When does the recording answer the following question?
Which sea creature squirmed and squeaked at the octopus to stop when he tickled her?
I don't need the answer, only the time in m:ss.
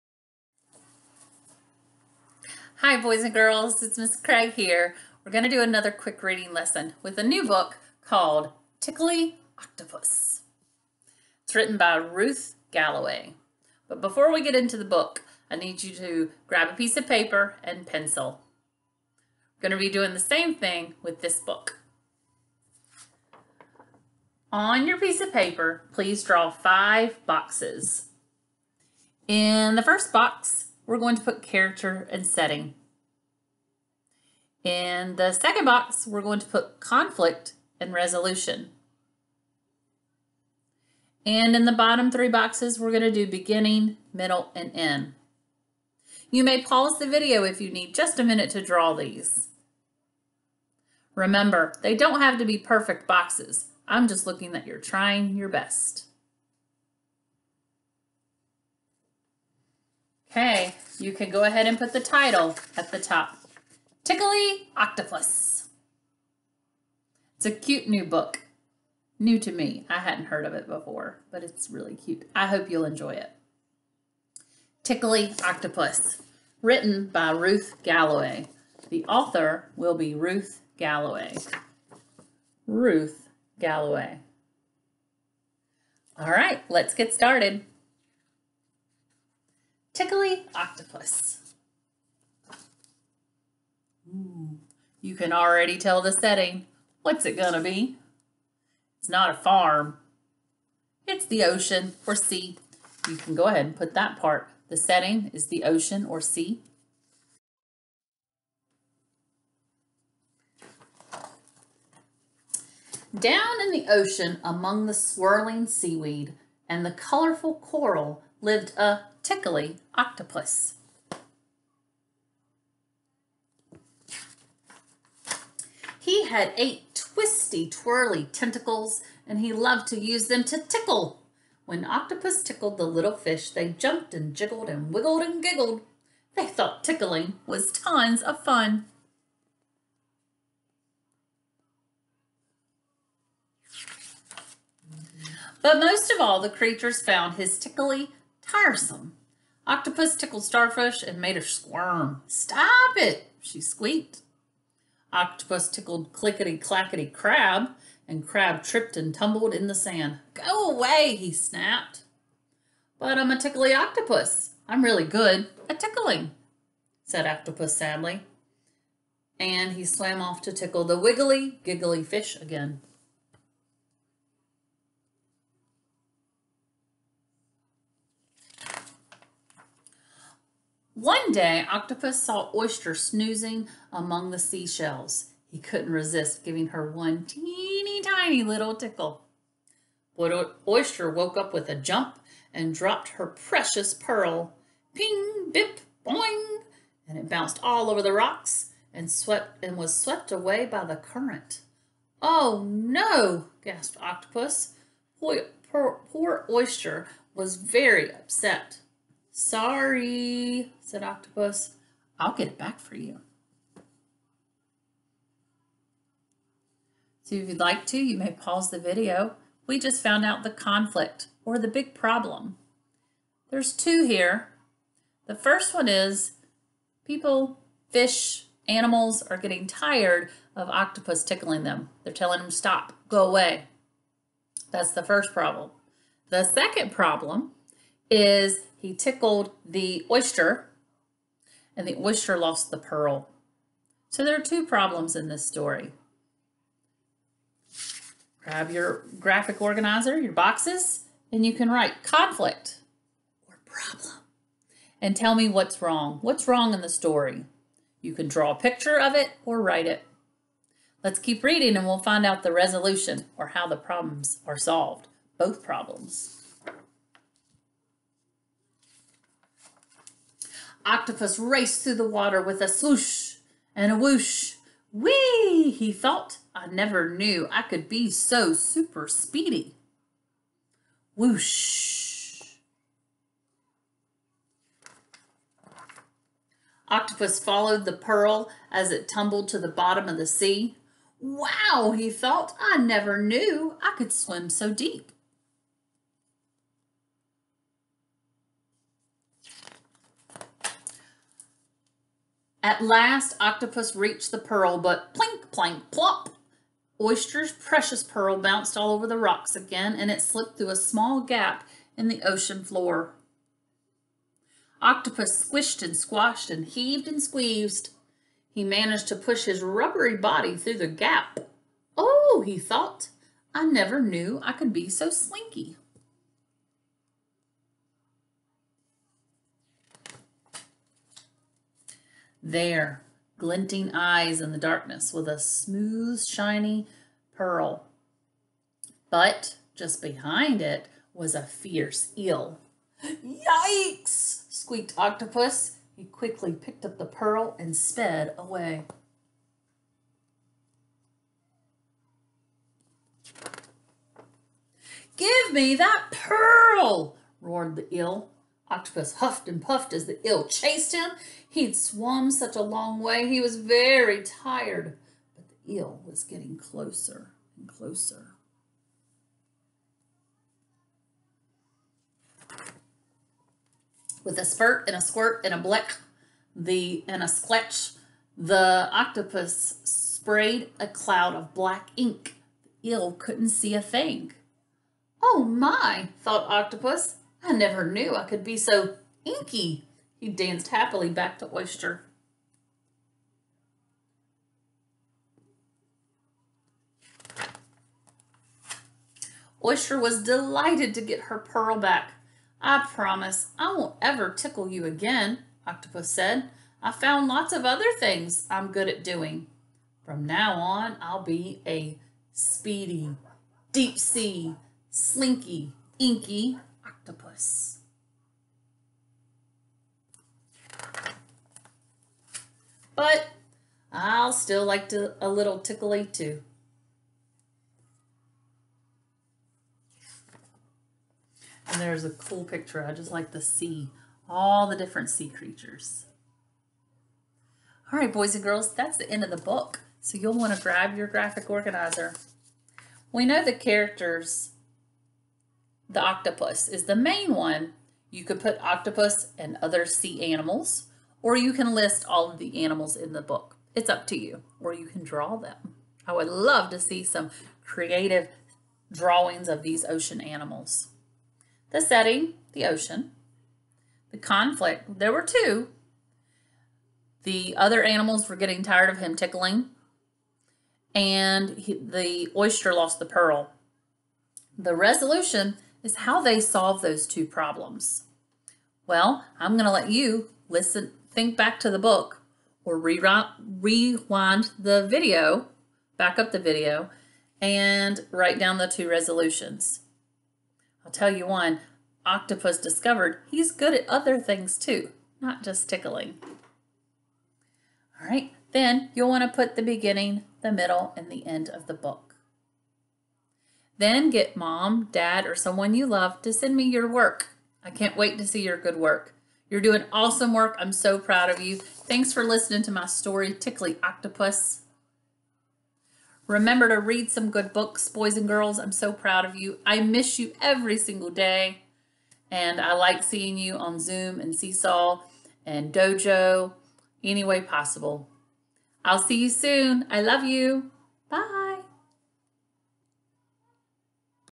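2:30.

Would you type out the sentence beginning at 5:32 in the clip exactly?
There, glinting eyes in the darkness with a smooth, shiny pearl.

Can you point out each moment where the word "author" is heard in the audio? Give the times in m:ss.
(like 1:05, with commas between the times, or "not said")
1:19.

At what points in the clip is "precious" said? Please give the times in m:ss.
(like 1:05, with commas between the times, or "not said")
3:13, 5:07.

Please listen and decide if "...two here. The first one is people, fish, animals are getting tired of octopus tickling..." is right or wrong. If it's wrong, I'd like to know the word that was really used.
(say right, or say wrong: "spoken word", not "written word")
right.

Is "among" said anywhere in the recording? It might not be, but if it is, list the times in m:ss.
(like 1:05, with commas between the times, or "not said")
1:54, 3:03.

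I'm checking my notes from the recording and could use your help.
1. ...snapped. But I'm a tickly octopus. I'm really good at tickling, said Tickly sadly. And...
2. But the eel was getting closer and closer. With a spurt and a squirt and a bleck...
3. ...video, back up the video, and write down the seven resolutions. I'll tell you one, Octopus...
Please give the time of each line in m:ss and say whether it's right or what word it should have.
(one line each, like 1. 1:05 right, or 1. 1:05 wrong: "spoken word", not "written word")
1. 2:41 wrong: "Octopus", not "Tickly"
2. 6:05 right
3. 8:04 wrong: "two", not "seven".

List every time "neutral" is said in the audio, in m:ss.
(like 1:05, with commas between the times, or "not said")
not said.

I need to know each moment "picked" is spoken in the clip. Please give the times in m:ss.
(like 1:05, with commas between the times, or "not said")
5:46.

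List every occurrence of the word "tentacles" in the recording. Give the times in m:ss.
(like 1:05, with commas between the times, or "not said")
2:08.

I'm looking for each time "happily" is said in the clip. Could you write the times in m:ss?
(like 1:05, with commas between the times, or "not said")
6:30.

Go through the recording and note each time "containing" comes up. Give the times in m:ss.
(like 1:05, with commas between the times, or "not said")
not said.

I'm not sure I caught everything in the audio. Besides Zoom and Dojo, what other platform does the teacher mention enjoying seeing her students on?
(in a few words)
Seesaw.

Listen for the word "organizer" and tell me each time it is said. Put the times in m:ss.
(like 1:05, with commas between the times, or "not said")
4:09, 7:21.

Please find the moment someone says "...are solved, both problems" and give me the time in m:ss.
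4:24.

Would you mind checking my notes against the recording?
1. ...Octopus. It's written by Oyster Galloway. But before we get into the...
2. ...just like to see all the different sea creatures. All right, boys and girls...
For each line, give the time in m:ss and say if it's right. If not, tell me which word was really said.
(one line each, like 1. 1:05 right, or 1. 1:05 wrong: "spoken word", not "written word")
1. 0:09 wrong: "Ruth", not "Oyster"
2. 7:12 right.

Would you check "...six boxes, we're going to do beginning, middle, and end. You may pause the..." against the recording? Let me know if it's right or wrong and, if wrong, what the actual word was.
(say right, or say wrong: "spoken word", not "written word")
wrong: "three", not "six".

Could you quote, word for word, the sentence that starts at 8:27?
I can't wait to see your good work.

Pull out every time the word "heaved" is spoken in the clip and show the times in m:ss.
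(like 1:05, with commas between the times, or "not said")
5:16.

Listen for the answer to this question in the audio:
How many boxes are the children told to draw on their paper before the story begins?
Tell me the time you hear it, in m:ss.
0:26.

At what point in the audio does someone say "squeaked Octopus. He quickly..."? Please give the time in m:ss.
5:44.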